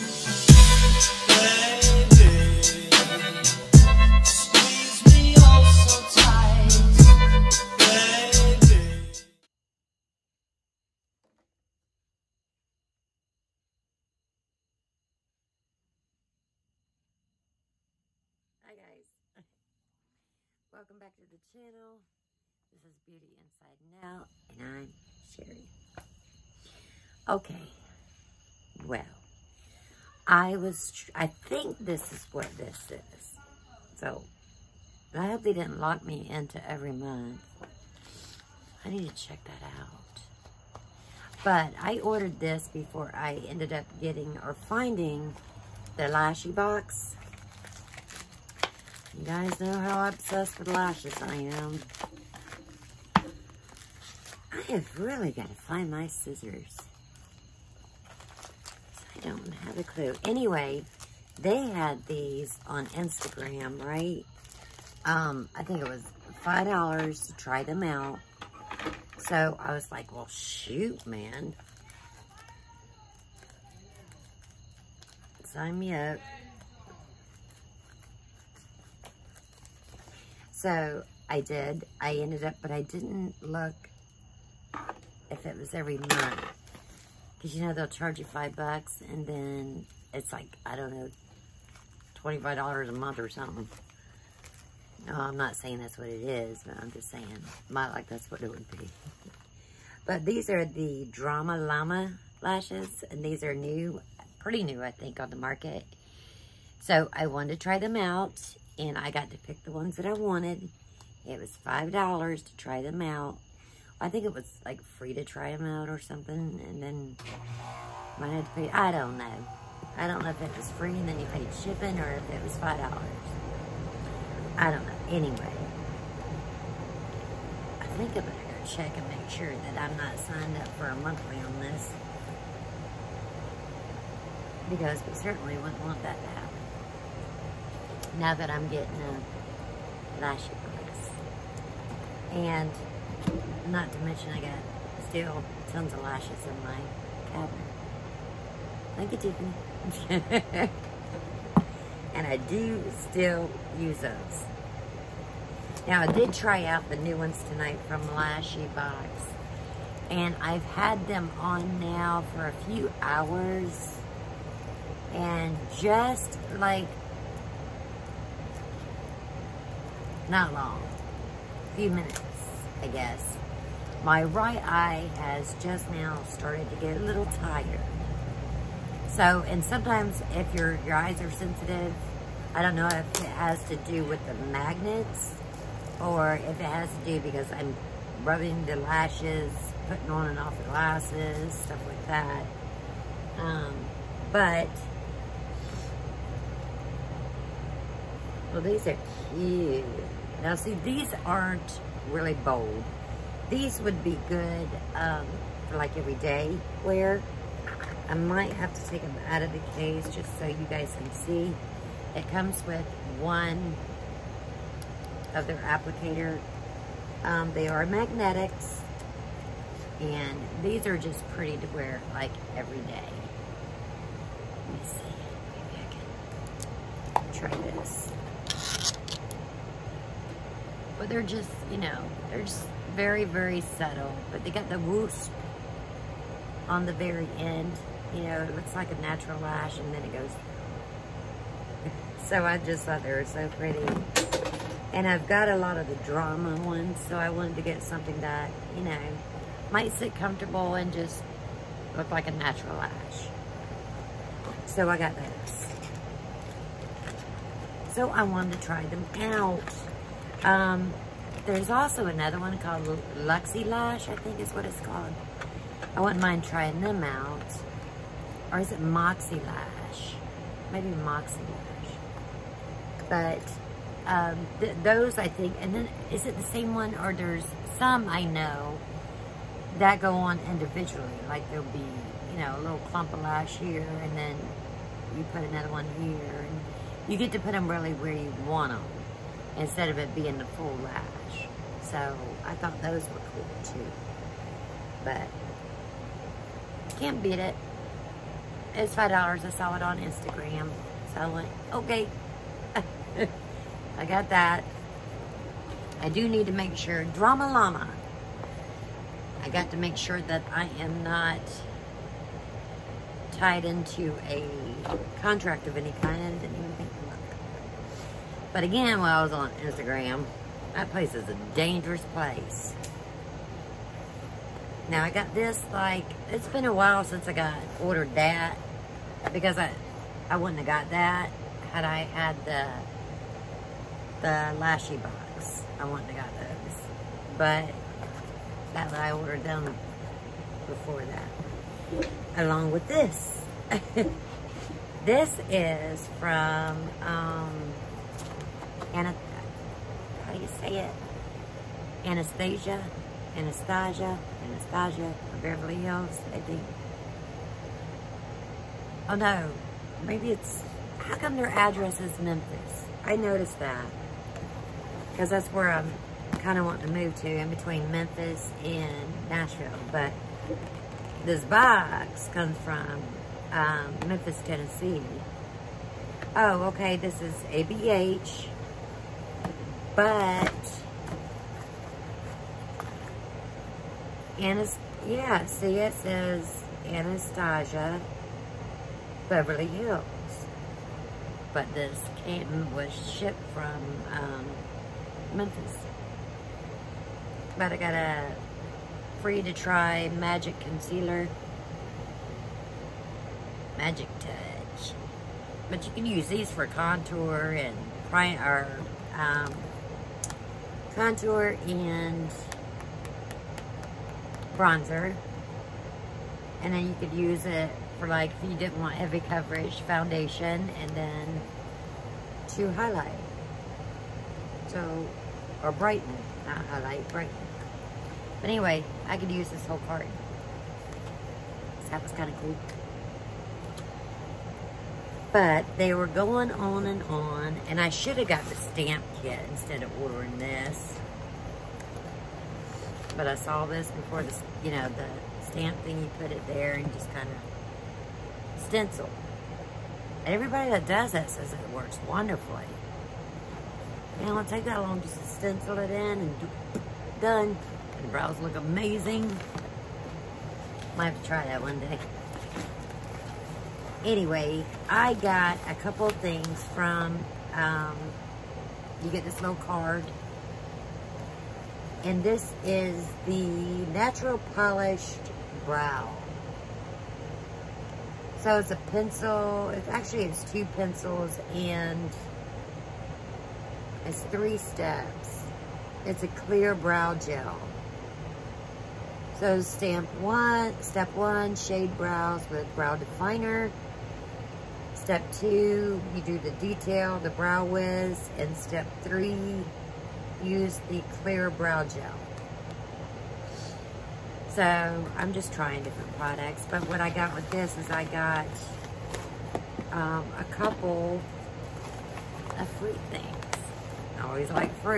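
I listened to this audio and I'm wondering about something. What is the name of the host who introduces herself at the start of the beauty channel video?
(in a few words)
Sherry.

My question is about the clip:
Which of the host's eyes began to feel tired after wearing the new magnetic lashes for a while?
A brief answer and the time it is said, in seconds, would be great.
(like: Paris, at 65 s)
Right eye, at 174 s.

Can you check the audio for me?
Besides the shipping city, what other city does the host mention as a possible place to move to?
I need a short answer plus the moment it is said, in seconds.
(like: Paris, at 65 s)
Nashville, at 369 s.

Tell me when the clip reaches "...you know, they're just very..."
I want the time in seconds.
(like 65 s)
231 s.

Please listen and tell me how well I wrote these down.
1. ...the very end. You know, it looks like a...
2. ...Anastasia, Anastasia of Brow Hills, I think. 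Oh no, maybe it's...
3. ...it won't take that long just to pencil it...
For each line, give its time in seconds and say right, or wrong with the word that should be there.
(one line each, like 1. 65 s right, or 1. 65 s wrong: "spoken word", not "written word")
1. 236 s right
2. 353 s wrong: "Beverly", not "Brow"
3. 454 s wrong: "stencil", not "pencil".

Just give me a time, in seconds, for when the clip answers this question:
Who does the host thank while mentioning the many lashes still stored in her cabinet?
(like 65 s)
150 s.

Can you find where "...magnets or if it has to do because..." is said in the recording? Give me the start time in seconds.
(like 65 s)
184 s.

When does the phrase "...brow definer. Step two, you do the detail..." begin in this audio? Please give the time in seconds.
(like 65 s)
492 s.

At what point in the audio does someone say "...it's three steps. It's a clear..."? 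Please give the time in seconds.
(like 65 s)
484 s.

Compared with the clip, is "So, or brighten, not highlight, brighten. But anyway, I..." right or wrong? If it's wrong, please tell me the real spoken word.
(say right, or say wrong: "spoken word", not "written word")
right.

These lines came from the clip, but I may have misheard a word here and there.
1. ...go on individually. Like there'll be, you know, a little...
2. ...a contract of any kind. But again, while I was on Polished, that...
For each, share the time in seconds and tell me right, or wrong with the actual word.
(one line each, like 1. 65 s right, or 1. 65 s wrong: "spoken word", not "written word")
1. 279 s right
2. 314 s wrong: "Instagram", not "Polished".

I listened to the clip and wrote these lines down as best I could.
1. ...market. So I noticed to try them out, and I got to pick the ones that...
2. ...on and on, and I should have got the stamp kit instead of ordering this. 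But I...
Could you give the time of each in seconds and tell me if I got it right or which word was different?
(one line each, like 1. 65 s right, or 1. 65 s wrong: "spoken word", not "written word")
1. 105 s wrong: "wanted", not "noticed"
2. 436 s right.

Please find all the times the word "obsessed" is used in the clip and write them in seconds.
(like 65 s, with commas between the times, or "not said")
50 s.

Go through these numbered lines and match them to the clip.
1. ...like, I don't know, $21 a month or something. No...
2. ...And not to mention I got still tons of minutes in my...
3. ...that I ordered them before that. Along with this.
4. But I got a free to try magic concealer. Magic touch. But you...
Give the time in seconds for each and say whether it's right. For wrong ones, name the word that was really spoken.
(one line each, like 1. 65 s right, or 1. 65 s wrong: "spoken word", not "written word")
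1. 90 s wrong: "25", not "21"
2. 142 s wrong: "lashes", not "minutes"
3. 338 s right
4. 397 s right.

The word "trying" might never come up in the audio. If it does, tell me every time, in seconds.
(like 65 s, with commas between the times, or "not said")
266 s, 505 s.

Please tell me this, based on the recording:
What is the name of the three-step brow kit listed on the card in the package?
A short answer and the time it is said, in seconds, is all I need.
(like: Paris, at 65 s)
Natural Polished Brow, at 473 s.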